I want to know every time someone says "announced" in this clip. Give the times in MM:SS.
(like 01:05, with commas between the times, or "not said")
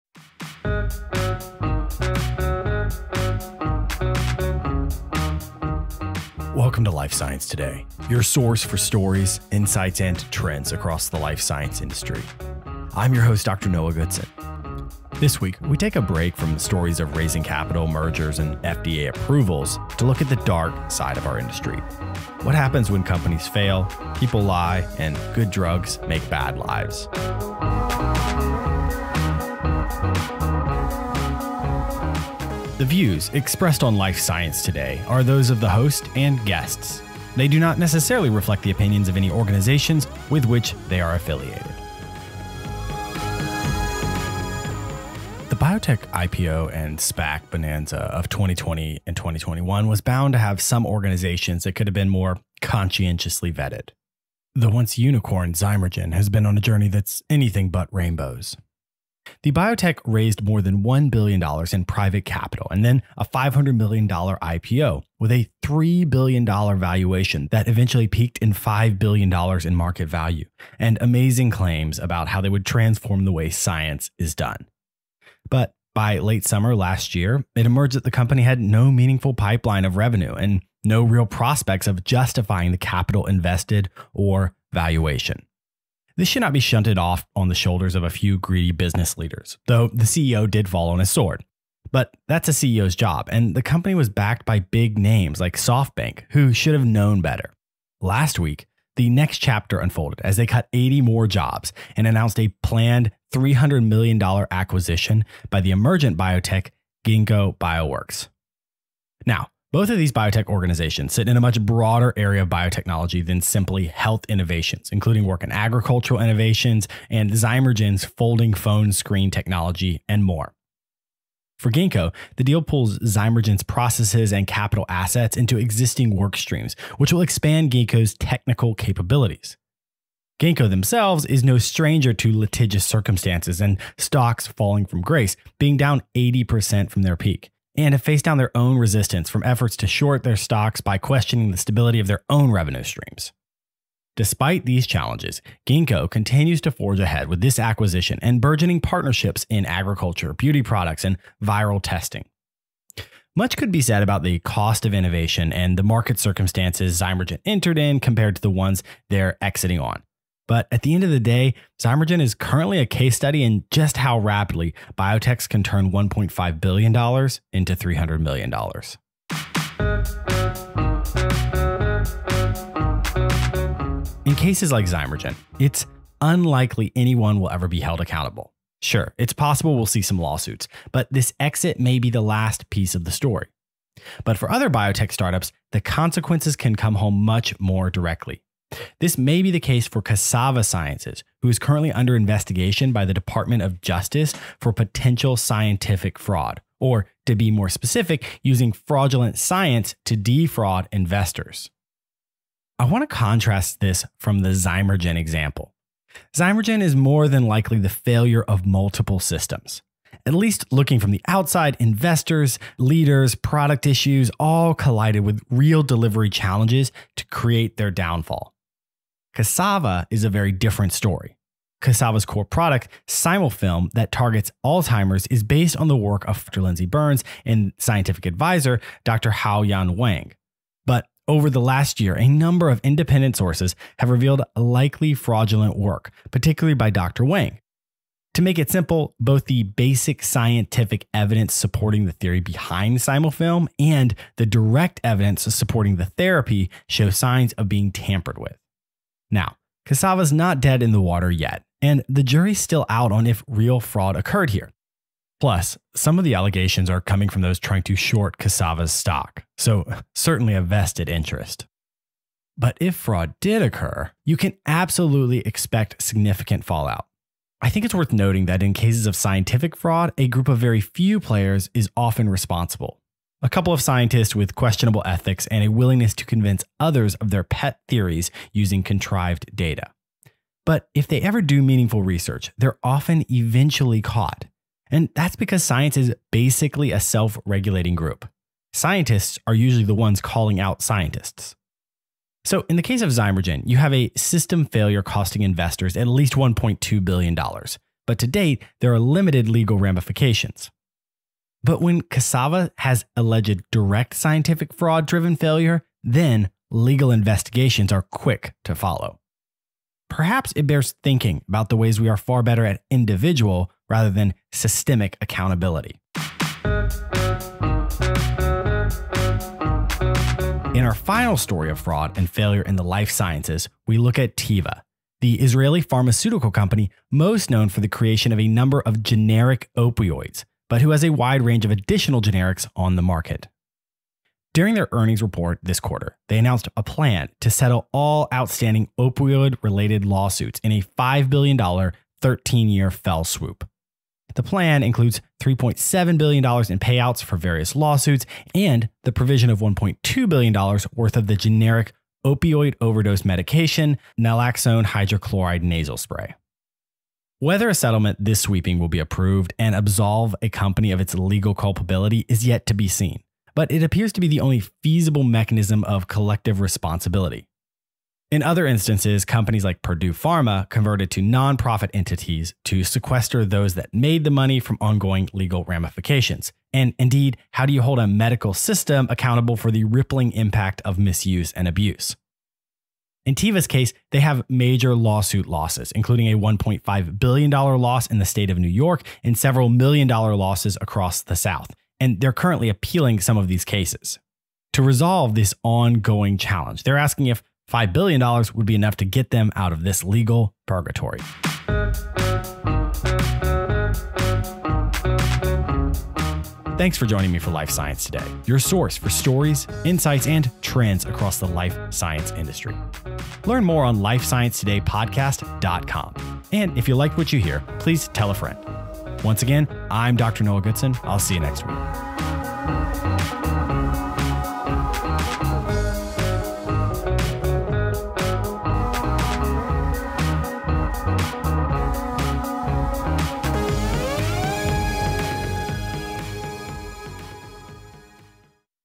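01:42, 05:36.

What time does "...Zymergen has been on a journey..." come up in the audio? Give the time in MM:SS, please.
00:55.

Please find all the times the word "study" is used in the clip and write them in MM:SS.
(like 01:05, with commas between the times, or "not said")
02:43.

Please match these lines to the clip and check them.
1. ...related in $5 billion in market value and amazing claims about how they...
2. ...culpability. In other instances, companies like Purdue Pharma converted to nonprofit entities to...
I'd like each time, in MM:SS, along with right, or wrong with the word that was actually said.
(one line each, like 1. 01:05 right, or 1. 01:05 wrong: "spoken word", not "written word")
1. 01:08 wrong: "peaked", not "related"
2. 06:06 wrong: "responsibility", not "culpability".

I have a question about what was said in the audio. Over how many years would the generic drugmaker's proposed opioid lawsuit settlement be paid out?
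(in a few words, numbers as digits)
13.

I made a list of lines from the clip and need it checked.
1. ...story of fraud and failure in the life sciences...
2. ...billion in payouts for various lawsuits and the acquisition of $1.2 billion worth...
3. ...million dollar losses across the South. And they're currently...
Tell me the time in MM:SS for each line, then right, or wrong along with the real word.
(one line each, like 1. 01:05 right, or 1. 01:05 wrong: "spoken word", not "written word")
1. 05:21 right
2. 05:46 wrong: "provision", not "acquisition"
3. 06:29 right.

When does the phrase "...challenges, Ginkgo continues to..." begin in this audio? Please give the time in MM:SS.
02:24.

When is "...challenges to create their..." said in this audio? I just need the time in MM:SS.
03:36.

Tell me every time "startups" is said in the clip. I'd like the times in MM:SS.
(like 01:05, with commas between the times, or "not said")
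03:05.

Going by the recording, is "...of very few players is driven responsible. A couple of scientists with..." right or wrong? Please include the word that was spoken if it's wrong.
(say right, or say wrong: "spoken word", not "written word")
wrong: "often", not "driven".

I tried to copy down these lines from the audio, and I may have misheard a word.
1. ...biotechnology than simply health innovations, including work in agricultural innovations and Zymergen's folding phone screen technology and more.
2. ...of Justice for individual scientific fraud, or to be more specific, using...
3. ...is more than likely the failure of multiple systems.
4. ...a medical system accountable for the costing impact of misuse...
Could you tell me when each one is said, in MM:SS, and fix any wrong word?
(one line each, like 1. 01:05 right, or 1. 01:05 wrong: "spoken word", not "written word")
1. 01:52 right
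2. 03:13 wrong: "potential", not "individual"
3. 03:26 right
4. 06:17 wrong: "rippling", not "costing".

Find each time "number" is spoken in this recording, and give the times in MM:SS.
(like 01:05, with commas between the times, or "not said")
03:52, 05:28.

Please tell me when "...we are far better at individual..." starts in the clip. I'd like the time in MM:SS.
05:12.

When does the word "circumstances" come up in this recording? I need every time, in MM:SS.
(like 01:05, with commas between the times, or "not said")
02:12, 02:36.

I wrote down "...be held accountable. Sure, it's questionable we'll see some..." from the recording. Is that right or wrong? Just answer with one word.
wrong.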